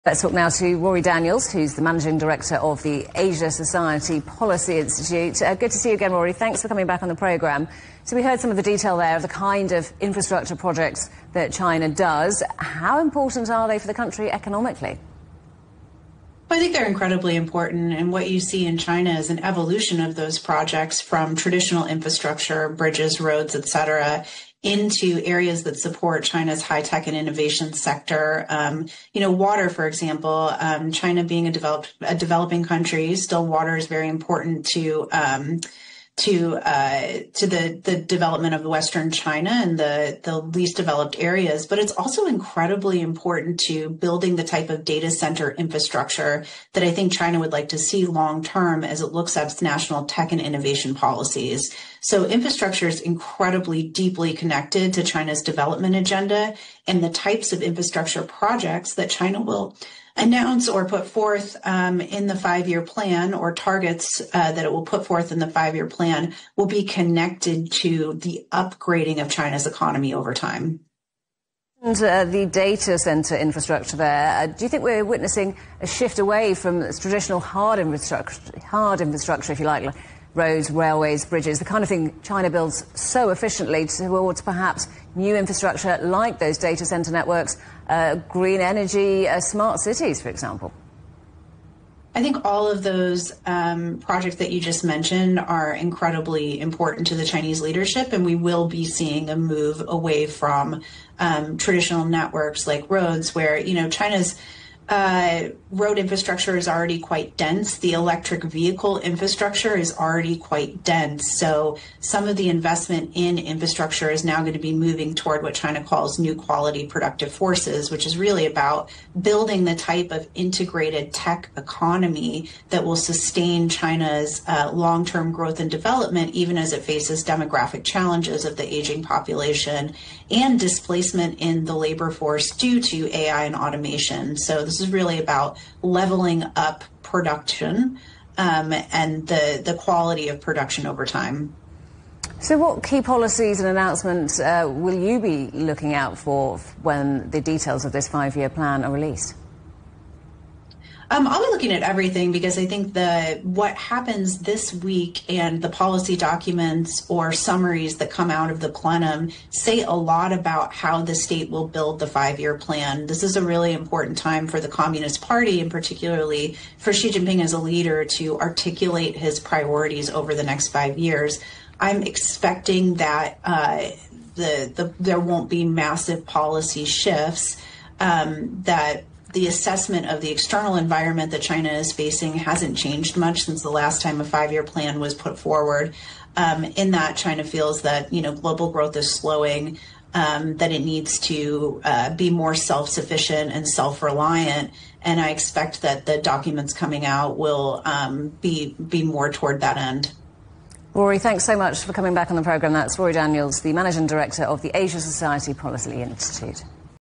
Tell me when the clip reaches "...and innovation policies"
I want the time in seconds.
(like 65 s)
50 s.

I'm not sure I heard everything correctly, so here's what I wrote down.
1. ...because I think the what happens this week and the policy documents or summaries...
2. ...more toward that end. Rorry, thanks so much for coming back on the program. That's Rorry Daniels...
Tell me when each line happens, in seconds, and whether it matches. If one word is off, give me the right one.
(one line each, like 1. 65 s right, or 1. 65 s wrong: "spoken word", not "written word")
1. 152 s right
2. 199 s right.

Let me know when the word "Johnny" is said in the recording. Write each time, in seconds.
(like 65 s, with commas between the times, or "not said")
not said.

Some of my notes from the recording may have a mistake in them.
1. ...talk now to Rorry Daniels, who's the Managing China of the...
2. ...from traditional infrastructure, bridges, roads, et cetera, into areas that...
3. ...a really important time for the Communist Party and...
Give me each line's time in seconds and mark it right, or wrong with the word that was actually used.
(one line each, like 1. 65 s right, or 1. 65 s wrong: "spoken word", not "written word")
1. 0 s wrong: "Director", not "China"
2. 20 s right
3. 163 s right.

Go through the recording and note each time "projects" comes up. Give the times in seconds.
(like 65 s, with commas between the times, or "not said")
10 s, 20 s, 58 s, 93 s.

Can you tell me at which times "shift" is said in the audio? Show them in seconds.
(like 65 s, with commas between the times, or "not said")
75 s, 176 s.